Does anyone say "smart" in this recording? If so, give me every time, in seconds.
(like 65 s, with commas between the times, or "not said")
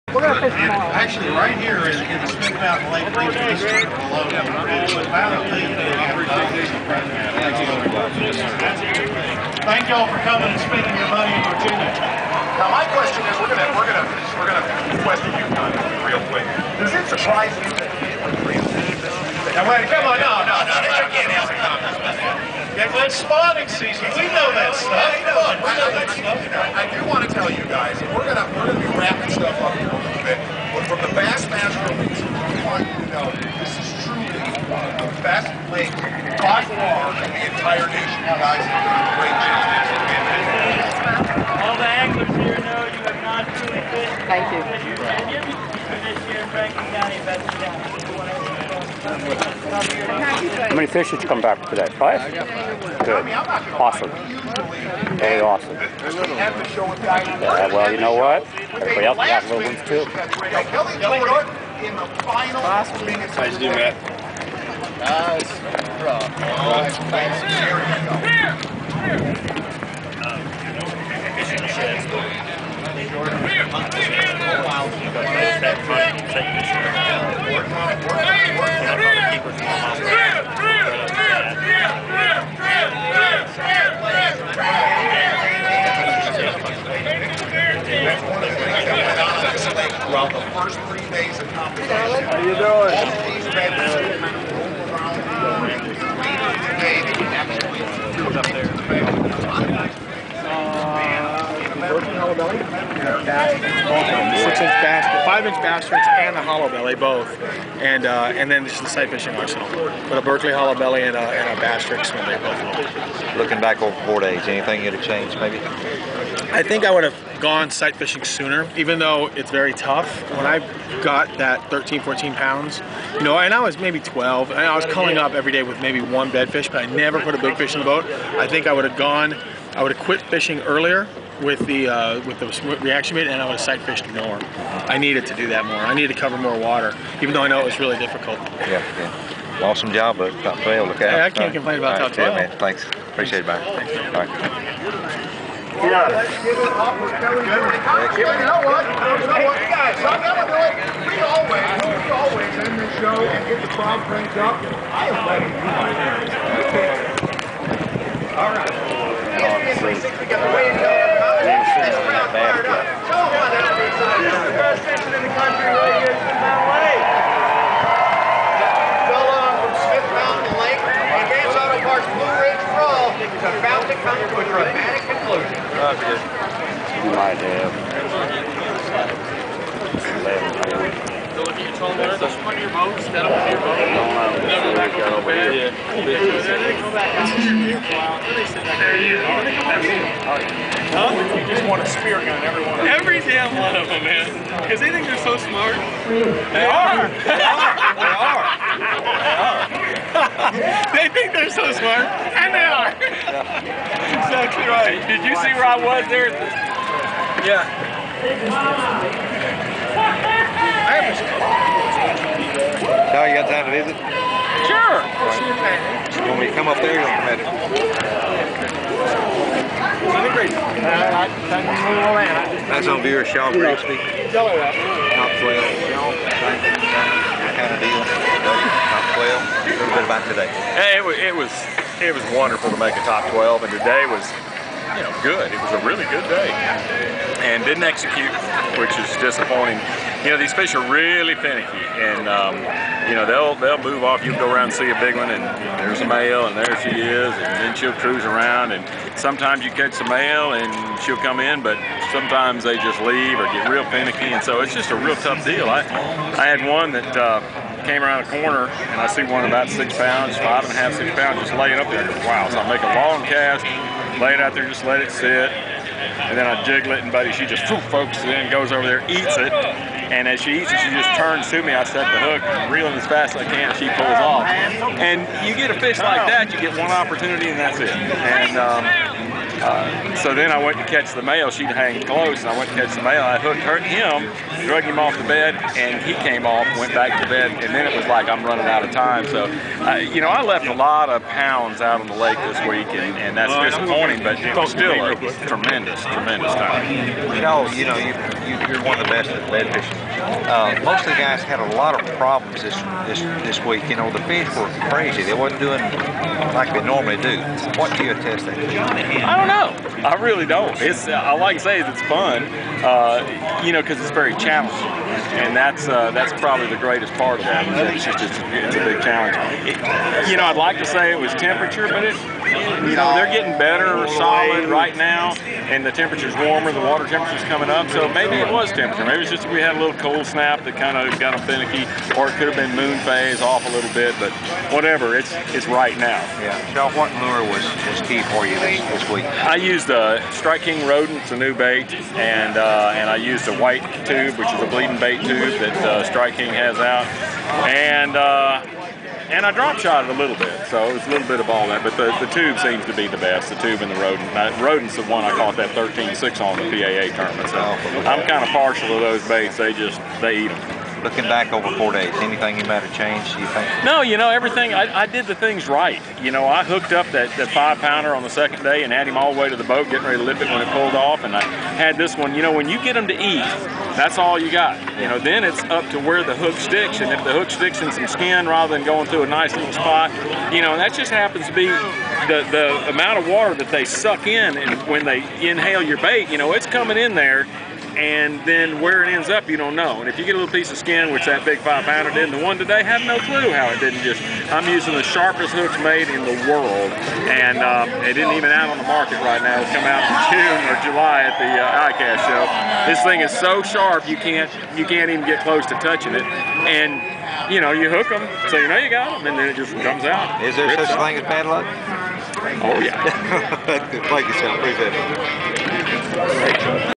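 195 s, 201 s.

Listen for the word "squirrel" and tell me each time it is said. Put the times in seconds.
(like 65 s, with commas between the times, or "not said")
not said.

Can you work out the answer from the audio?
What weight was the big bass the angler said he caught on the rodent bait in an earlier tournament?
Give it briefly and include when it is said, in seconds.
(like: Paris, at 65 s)
13-6, at 355 s.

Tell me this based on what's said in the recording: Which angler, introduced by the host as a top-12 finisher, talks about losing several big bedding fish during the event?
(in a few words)
Shaw Grigsby.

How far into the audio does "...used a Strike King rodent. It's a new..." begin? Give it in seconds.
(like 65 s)
339 s.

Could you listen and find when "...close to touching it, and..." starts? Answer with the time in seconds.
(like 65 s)
405 s.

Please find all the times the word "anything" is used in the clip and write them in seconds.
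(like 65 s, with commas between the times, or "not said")
114 s, 362 s.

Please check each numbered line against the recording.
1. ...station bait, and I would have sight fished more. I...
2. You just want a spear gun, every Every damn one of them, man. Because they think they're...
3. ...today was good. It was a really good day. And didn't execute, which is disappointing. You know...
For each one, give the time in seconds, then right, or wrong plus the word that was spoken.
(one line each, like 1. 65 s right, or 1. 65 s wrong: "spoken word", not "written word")
1. 132 s wrong: "reaction", not "station"
2. 191 s right
3. 233 s right.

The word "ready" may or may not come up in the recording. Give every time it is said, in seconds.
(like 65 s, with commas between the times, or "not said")
370 s.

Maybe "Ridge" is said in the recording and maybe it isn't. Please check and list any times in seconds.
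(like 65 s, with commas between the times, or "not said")
172 s.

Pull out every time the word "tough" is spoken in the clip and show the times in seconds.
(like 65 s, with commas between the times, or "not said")
119 s, 255 s.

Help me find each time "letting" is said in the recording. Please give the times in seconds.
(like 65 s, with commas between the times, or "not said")
155 s.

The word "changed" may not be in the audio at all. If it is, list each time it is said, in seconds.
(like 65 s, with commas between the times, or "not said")
115 s, 362 s.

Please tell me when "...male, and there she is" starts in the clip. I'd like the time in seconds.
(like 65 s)
246 s.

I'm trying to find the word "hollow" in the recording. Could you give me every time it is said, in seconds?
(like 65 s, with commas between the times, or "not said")
106 s, 110 s.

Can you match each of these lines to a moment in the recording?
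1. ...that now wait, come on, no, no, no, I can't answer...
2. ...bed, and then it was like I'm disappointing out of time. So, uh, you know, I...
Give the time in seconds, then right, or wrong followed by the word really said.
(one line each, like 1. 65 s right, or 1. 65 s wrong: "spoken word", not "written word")
1. 17 s right
2. 287 s wrong: "running", not "disappointing".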